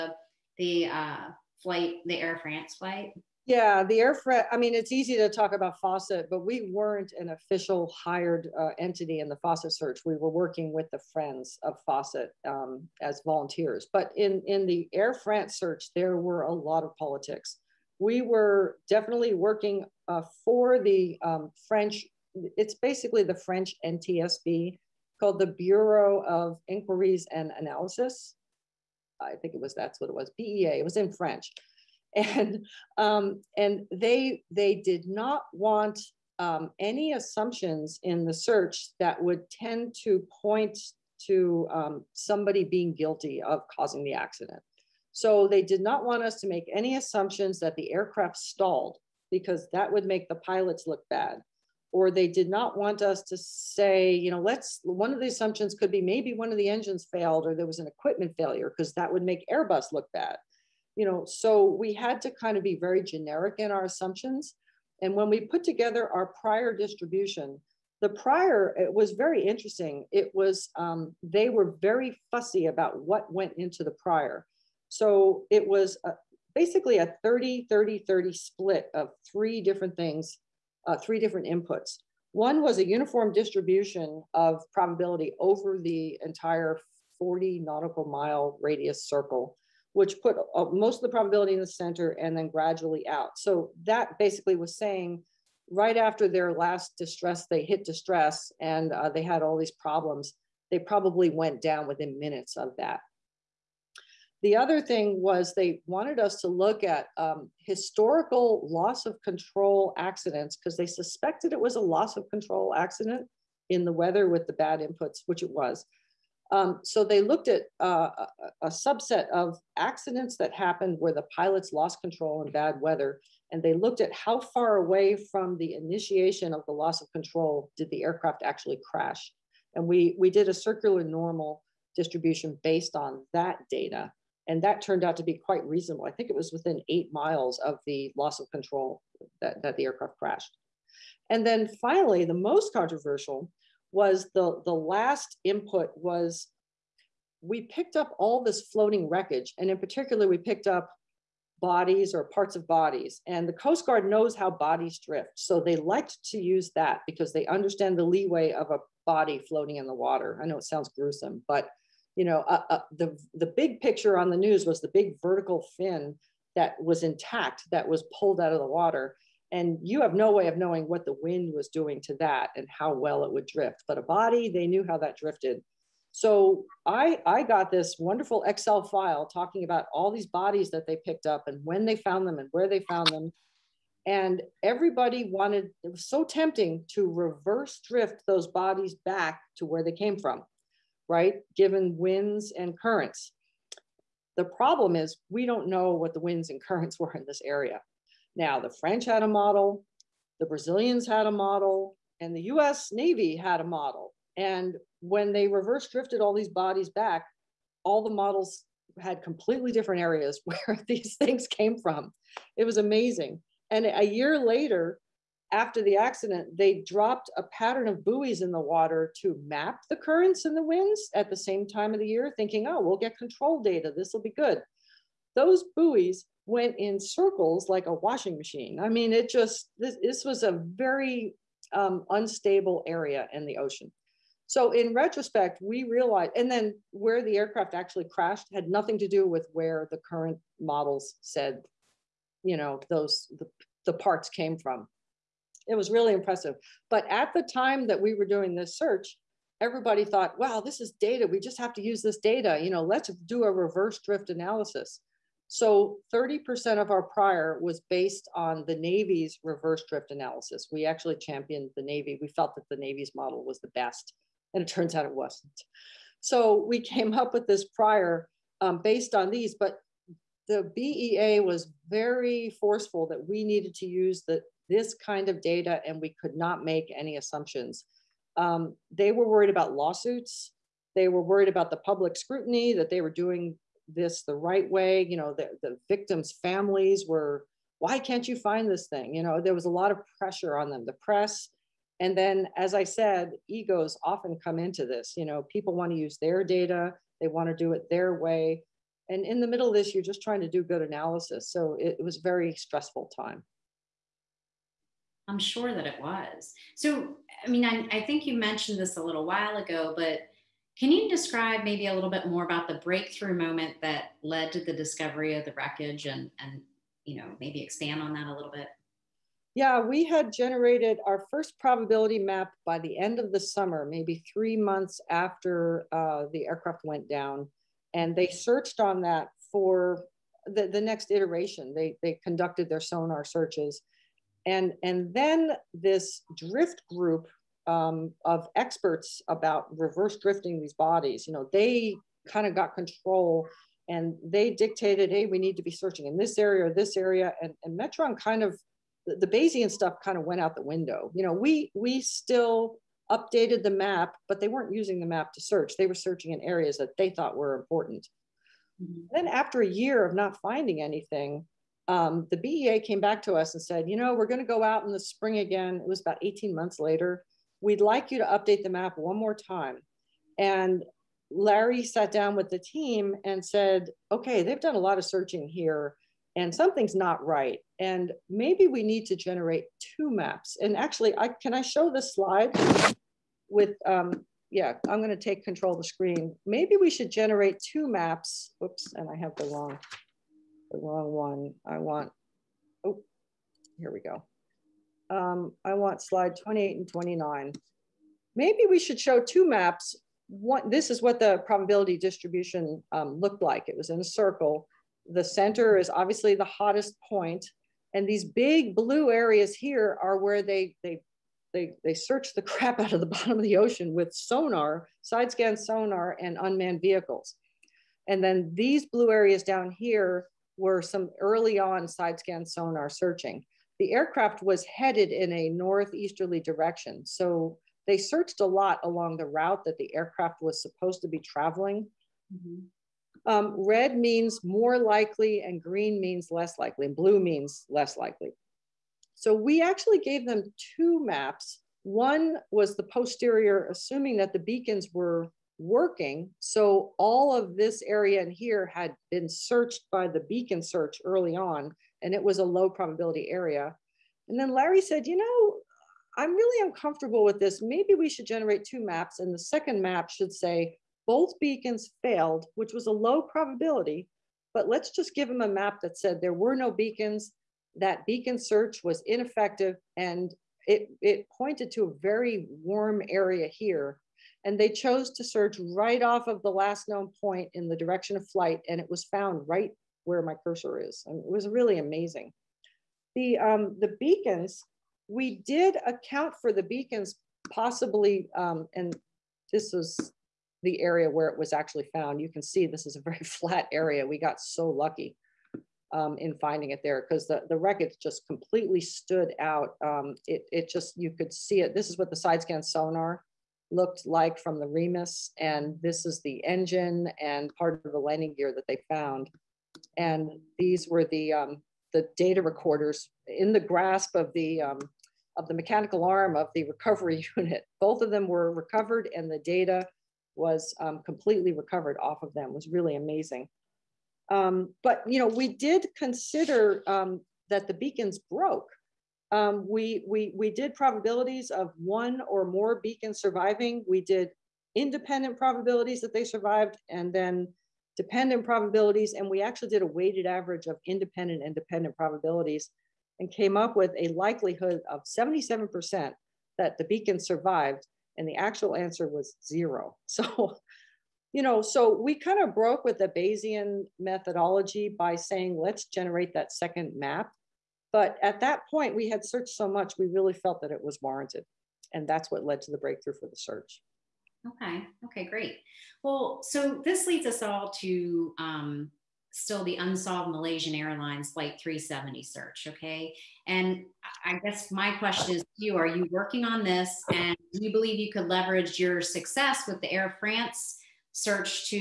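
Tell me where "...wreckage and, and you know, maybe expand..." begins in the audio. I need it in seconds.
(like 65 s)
315 s.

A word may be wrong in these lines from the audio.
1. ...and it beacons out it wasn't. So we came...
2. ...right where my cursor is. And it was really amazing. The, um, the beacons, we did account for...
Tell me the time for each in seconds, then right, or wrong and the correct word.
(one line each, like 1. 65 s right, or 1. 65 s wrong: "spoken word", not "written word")
1. 264 s wrong: "turns", not "beacons"
2. 479 s right.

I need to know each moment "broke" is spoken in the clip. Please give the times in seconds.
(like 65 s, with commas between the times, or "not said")
528 s, 552 s.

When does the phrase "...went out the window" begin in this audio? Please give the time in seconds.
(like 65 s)
350 s.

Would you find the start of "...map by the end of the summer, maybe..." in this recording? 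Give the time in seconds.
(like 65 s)
322 s.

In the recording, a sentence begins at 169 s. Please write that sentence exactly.
And you have no way of knowing what the wind was doing to that and how well it would drift.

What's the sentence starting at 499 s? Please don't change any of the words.
Um, it, it just, you could see it.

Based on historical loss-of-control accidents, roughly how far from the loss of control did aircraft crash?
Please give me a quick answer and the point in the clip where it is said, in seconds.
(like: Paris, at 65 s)
8 miles, at 136 s.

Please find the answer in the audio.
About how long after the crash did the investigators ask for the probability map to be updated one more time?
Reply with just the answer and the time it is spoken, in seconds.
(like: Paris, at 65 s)
18 months, at 366 s.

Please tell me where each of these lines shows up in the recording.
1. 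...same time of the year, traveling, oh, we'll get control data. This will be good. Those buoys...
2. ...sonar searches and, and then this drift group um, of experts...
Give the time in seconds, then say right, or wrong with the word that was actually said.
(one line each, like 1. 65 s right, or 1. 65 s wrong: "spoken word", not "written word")
1. 221 s wrong: "thinking", not "traveling"
2. 332 s right.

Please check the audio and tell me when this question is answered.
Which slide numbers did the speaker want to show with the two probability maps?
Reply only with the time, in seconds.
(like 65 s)
396 s.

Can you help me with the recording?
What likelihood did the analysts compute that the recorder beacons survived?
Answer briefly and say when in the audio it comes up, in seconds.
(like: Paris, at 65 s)
77%, at 545 s.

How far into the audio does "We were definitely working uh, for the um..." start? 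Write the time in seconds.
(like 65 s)
17 s.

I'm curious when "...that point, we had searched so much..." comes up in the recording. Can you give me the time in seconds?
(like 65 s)
558 s.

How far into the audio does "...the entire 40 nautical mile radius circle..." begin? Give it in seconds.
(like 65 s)
85 s.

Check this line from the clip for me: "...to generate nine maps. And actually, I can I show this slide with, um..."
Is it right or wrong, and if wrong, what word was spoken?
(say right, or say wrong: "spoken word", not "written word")
wrong: "two", not "nine".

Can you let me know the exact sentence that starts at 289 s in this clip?
You know, there was a lot of pressure on them, the press.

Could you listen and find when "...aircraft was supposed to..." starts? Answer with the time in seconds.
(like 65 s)
429 s.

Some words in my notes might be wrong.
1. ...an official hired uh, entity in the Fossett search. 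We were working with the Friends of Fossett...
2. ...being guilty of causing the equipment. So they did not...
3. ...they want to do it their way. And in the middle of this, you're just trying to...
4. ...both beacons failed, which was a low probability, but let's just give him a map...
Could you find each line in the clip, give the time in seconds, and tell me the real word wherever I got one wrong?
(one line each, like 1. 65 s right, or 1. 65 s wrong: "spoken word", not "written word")
1. 7 s right
2. 42 s wrong: "accident", not "equipment"
3. 297 s right
4. 461 s right.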